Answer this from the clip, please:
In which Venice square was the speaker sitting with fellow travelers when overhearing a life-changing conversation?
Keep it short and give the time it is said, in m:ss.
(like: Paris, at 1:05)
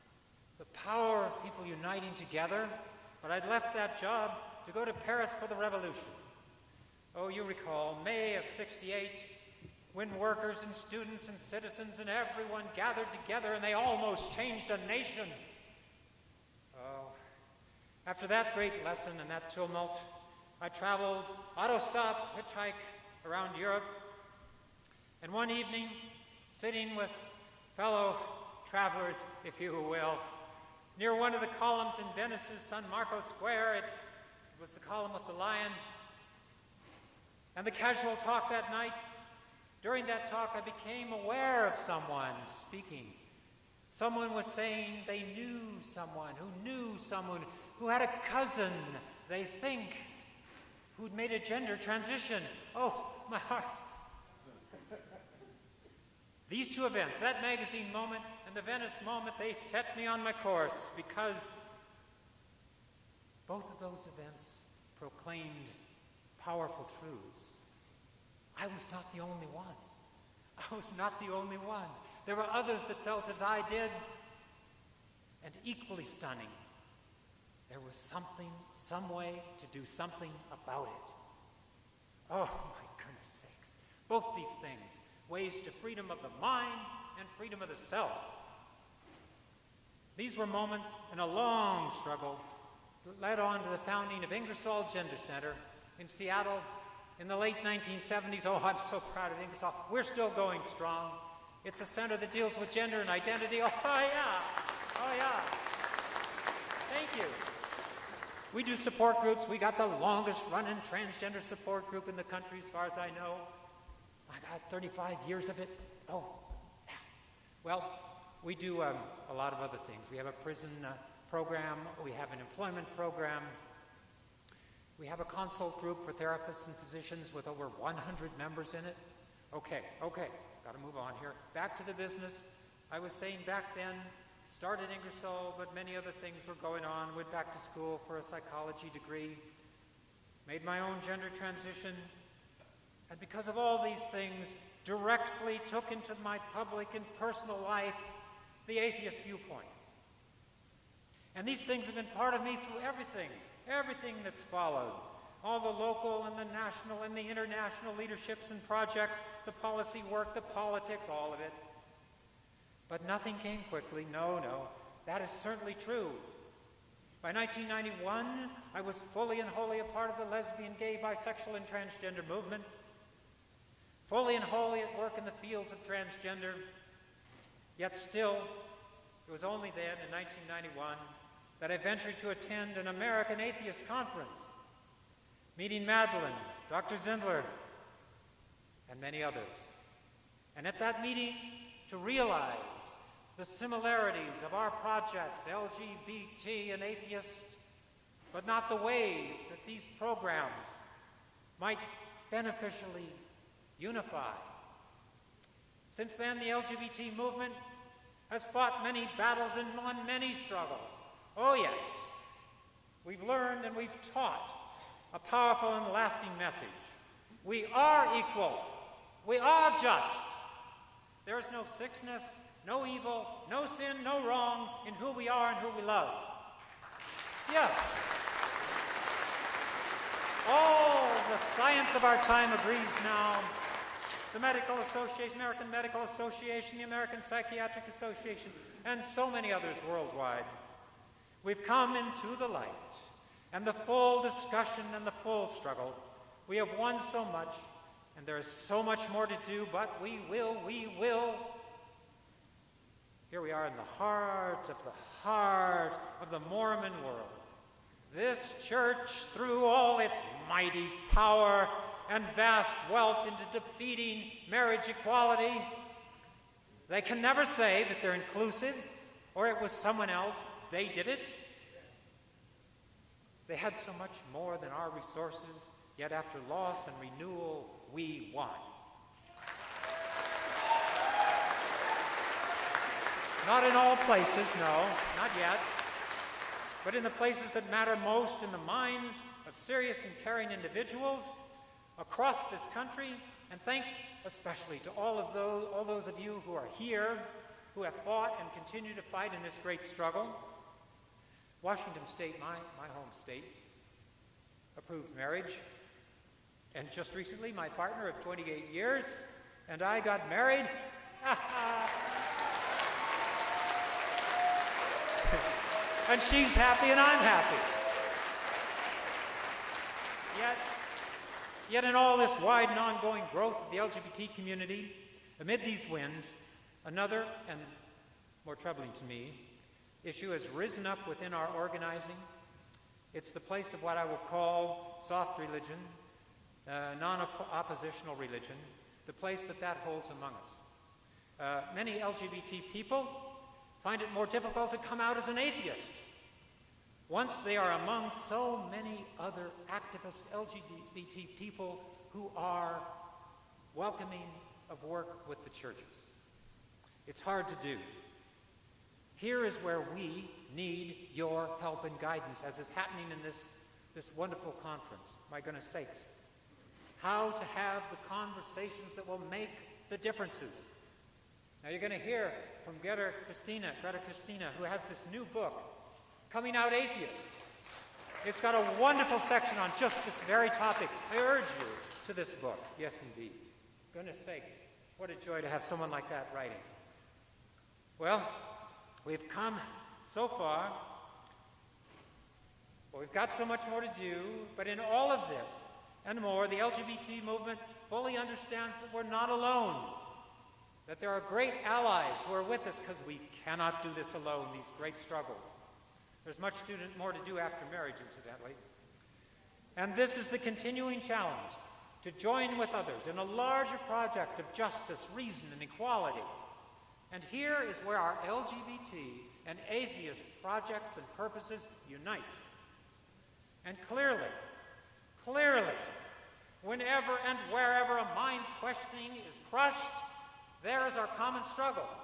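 San Marco Square, at 0:32.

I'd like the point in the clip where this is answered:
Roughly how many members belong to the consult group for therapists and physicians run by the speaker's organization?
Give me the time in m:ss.
2:07.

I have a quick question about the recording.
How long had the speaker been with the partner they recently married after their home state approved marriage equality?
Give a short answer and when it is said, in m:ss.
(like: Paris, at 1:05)
28 years, at 5:08.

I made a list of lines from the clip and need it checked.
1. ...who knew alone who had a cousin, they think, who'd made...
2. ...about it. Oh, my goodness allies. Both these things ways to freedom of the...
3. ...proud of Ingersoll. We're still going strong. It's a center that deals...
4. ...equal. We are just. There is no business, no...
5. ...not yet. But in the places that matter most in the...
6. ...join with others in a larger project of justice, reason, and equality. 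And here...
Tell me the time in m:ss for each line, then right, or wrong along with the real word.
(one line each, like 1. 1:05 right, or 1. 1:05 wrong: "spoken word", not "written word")
1. 0:46 wrong: "someone", not "alone"
2. 1:20 wrong: "sakes", not "allies"
3. 1:39 right
4. 3:38 wrong: "sickness", not "business"
5. 4:45 right
6. 6:52 right.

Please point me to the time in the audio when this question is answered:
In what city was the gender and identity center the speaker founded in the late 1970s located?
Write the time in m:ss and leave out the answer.
1:36.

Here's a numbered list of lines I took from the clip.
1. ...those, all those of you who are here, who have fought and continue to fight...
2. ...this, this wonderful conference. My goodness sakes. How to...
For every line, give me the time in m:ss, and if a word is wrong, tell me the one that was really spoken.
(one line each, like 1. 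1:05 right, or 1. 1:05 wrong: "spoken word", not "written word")
1. 4:55 right
2. 6:03 right.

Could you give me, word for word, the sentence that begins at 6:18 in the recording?
It's got a wonderful section on just this very topic.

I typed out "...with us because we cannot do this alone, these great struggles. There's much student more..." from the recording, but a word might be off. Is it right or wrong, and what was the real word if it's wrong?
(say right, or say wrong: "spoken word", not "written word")
right.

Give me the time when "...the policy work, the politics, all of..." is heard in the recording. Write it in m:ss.
2:39.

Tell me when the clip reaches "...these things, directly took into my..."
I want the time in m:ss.
2:23.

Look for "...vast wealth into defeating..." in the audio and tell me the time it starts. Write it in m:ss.
4:22.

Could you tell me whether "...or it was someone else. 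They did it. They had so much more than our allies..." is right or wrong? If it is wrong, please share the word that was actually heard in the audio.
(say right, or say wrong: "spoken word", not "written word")
wrong: "resources", not "allies".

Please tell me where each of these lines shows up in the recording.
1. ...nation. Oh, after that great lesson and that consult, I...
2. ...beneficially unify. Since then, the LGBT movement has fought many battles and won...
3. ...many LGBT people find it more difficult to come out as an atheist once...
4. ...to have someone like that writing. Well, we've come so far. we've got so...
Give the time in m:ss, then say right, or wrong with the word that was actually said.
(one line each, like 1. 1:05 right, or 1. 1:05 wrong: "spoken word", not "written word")
1. 0:14 wrong: "tumult", not "consult"
2. 3:22 right
3. 5:41 right
4. 6:25 right.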